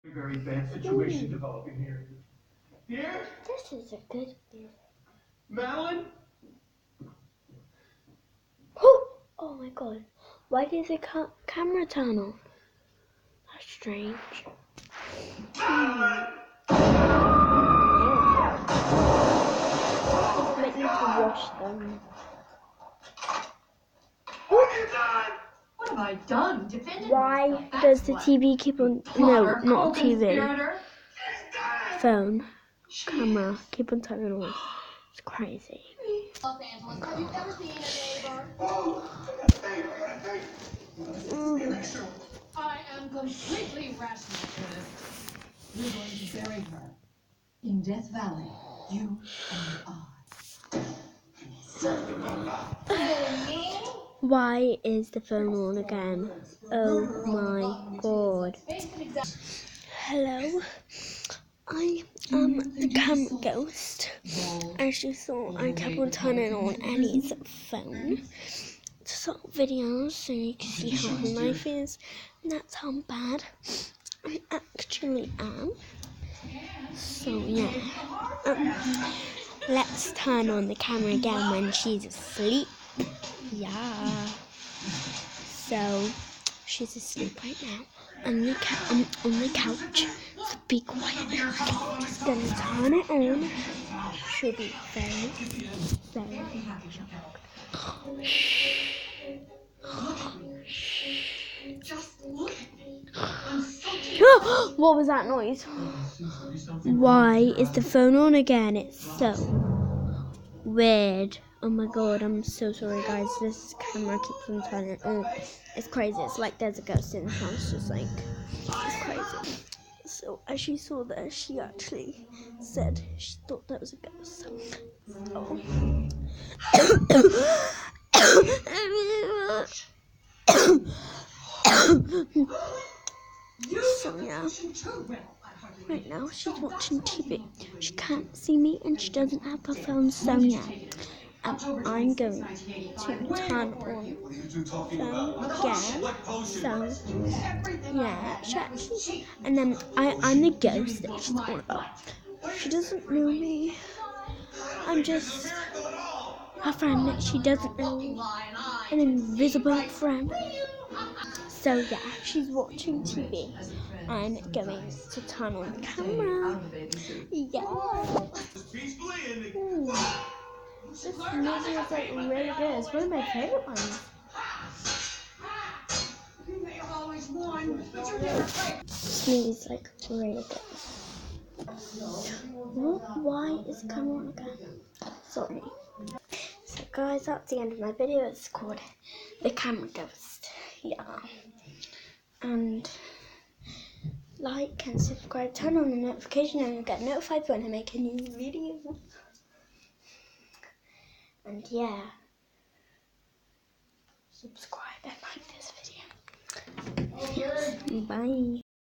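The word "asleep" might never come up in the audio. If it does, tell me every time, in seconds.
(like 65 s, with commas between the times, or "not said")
82 s, 86 s.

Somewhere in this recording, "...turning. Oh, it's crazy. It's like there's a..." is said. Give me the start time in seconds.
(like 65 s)
114 s.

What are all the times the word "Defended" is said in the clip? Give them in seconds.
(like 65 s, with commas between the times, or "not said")
26 s.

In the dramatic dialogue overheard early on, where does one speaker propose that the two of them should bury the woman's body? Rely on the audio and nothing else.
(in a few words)
Death Valley.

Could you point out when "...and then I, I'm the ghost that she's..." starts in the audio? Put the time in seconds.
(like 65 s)
149 s.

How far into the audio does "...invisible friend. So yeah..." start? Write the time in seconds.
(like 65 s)
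158 s.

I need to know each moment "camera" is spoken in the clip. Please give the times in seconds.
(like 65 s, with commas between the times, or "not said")
11 s, 33 s, 62 s, 80 s, 113 s, 165 s, 189 s.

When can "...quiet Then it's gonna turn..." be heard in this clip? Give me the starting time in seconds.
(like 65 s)
90 s.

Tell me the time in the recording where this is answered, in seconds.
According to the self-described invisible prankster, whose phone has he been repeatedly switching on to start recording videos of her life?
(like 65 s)
66 s.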